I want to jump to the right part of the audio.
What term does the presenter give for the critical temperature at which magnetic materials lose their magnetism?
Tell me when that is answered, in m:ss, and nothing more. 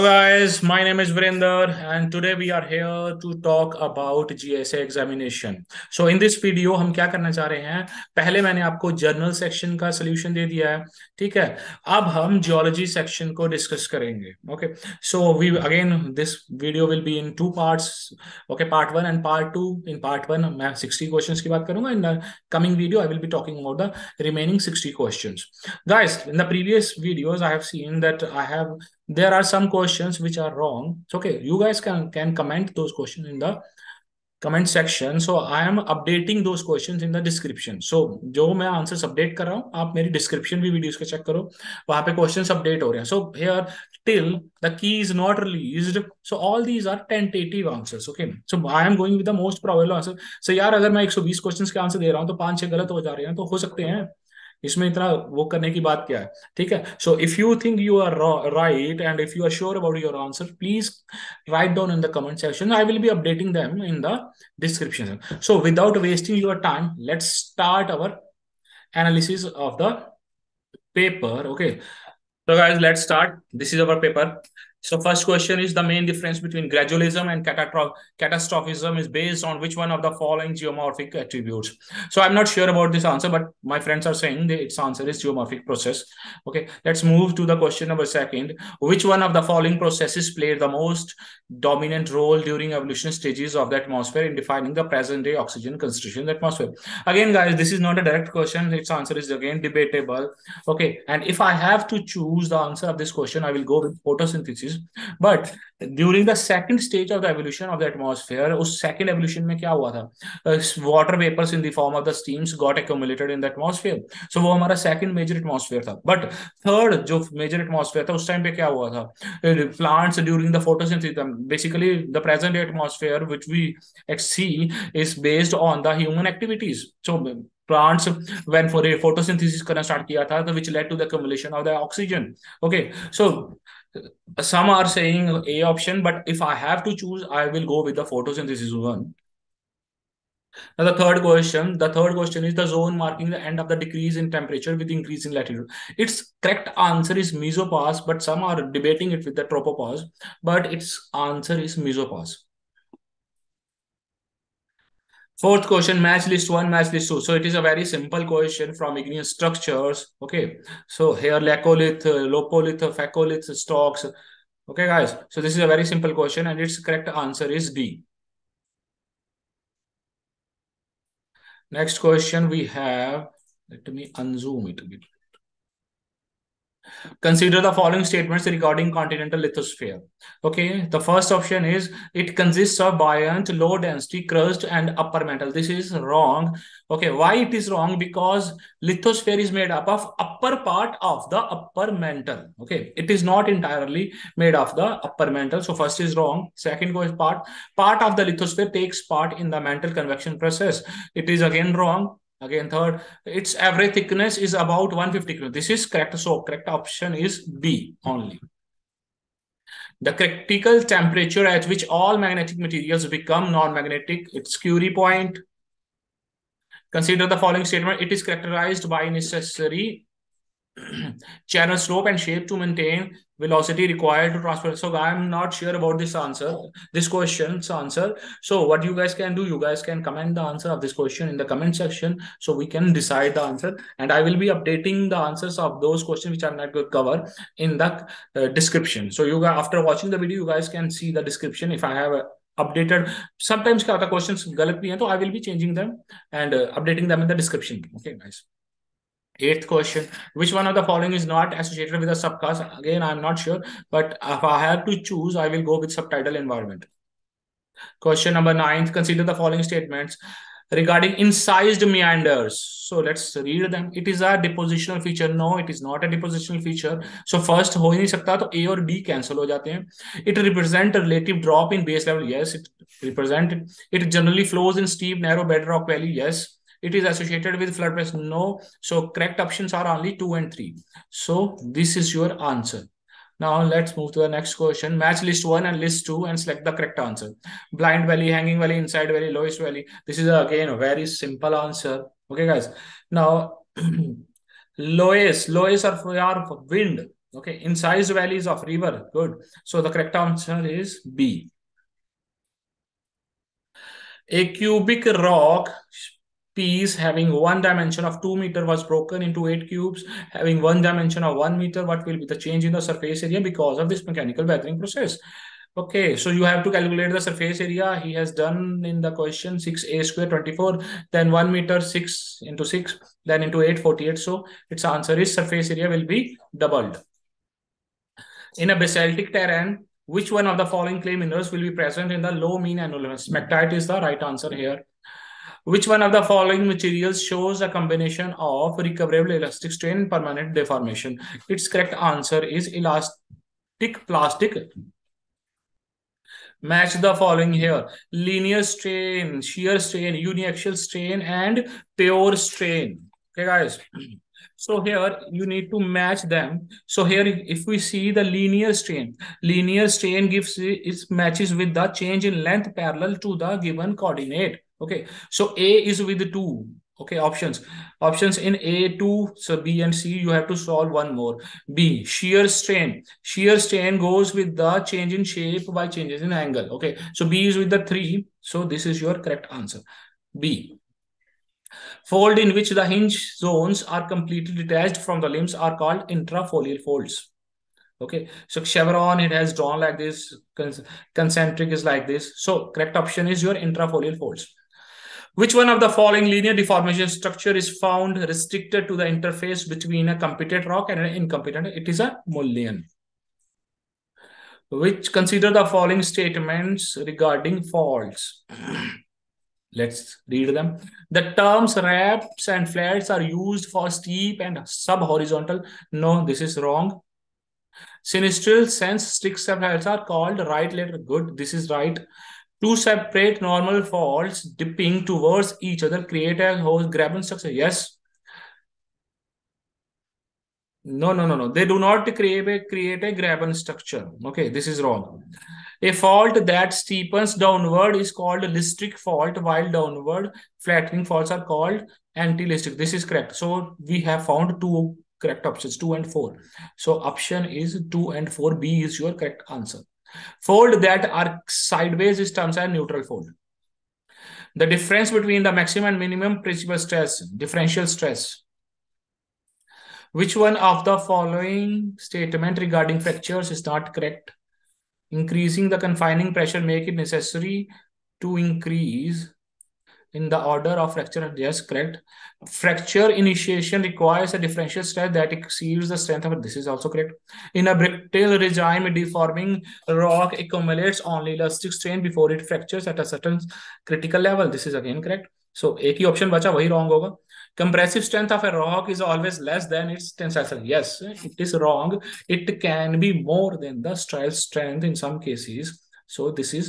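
3:34.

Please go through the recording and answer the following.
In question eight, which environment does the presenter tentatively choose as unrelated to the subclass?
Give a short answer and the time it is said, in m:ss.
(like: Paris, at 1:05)
Subtidal environment, at 4:15.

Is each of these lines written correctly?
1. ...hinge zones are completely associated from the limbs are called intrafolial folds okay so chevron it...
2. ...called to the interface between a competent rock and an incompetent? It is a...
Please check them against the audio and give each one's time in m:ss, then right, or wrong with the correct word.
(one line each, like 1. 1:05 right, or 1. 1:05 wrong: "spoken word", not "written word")
1. 6:22 wrong: "detached", not "associated"
2. 6:38 wrong: "restricted", not "called".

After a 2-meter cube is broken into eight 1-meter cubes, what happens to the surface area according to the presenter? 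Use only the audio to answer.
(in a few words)
Doubled.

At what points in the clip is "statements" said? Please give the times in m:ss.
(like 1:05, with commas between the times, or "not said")
2:58, 3:37, 4:19, 6:46, 7:41.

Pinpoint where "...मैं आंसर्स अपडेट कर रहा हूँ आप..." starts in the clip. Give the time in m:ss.
0:38.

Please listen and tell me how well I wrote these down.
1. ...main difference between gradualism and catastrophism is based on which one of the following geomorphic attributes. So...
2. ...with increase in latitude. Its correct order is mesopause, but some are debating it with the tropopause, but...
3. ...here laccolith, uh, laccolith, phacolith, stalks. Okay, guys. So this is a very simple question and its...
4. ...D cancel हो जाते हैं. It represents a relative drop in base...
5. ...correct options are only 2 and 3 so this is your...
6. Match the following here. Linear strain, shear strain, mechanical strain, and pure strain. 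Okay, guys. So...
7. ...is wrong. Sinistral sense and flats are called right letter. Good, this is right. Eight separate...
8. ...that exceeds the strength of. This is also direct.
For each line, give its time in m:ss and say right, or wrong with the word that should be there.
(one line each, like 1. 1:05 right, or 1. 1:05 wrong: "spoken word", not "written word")
1. 1:15 right
2. 2:24 wrong: "answer", not "order"
3. 2:41 wrong: "lopolith", not "laccolith"
4. 4:28 right
5. 4:39 right
6. 5:46 wrong: "uniaxial", not "mechanical"
7. 6:56 wrong: "Two", not "Eight"
8. 7:55 wrong: "correct", not "direct".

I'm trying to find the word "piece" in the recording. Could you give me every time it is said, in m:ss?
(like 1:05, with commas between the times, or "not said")
5:06.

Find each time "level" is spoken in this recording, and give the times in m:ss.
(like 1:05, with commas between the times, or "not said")
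4:32, 8:04.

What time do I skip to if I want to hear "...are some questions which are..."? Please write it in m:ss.
0:29.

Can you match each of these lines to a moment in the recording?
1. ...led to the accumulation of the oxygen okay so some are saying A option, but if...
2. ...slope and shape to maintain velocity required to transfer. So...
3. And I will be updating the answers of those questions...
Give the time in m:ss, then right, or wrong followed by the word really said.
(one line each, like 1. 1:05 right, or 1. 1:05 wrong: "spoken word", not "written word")
1. 2:10 right
2. 3:41 right
3. 3:53 right.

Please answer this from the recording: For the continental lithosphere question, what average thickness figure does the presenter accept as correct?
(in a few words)
150.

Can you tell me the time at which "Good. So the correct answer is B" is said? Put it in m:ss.
4:59.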